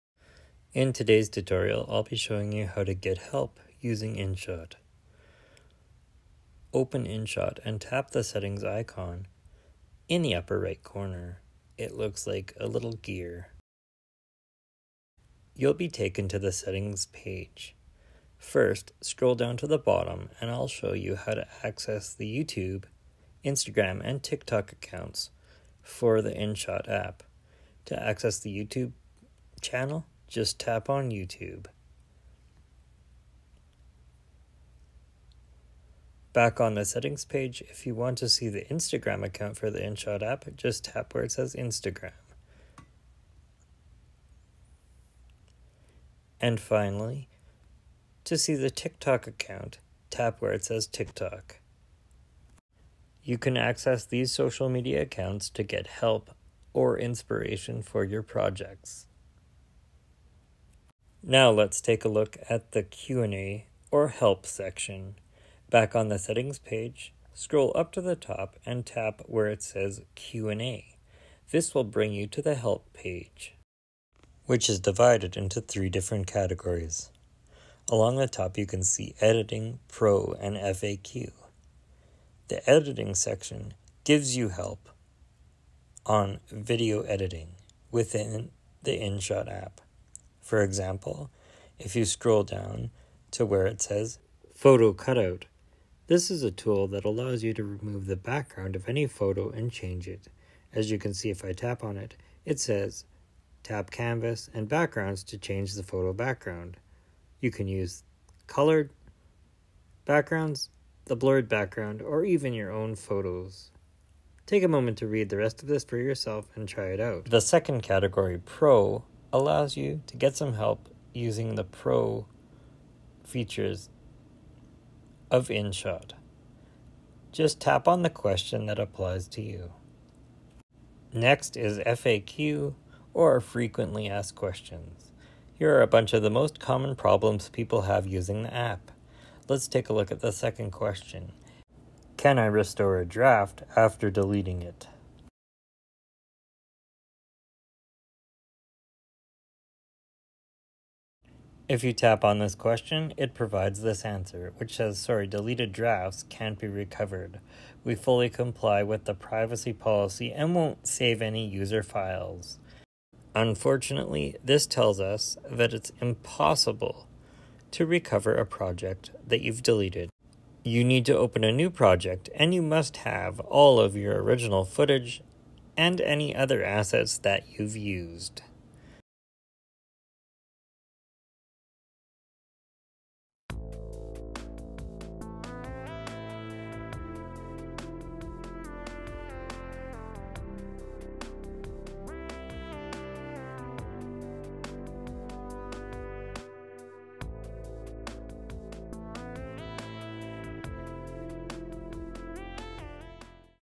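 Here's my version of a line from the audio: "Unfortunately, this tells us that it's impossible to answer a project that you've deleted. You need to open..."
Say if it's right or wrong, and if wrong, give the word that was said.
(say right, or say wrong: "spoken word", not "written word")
wrong: "recover", not "answer".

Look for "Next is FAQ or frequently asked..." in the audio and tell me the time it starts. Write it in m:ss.
2:11.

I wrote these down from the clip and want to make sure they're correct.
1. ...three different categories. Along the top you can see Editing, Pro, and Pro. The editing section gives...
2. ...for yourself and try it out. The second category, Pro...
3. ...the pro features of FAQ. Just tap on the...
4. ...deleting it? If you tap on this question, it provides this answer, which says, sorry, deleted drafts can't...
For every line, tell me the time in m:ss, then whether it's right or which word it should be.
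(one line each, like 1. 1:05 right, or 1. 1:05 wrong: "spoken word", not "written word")
1. 1:15 wrong: "FAQ", not "Pro"
2. 1:55 right
3. 2:01 wrong: "InShot", not "FAQ"
4. 2:24 right.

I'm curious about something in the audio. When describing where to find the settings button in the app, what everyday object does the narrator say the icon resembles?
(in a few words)
A little gear.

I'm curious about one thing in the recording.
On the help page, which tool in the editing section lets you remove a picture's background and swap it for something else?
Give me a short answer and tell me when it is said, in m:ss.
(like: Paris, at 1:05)
Photo Cutout, at 1:34.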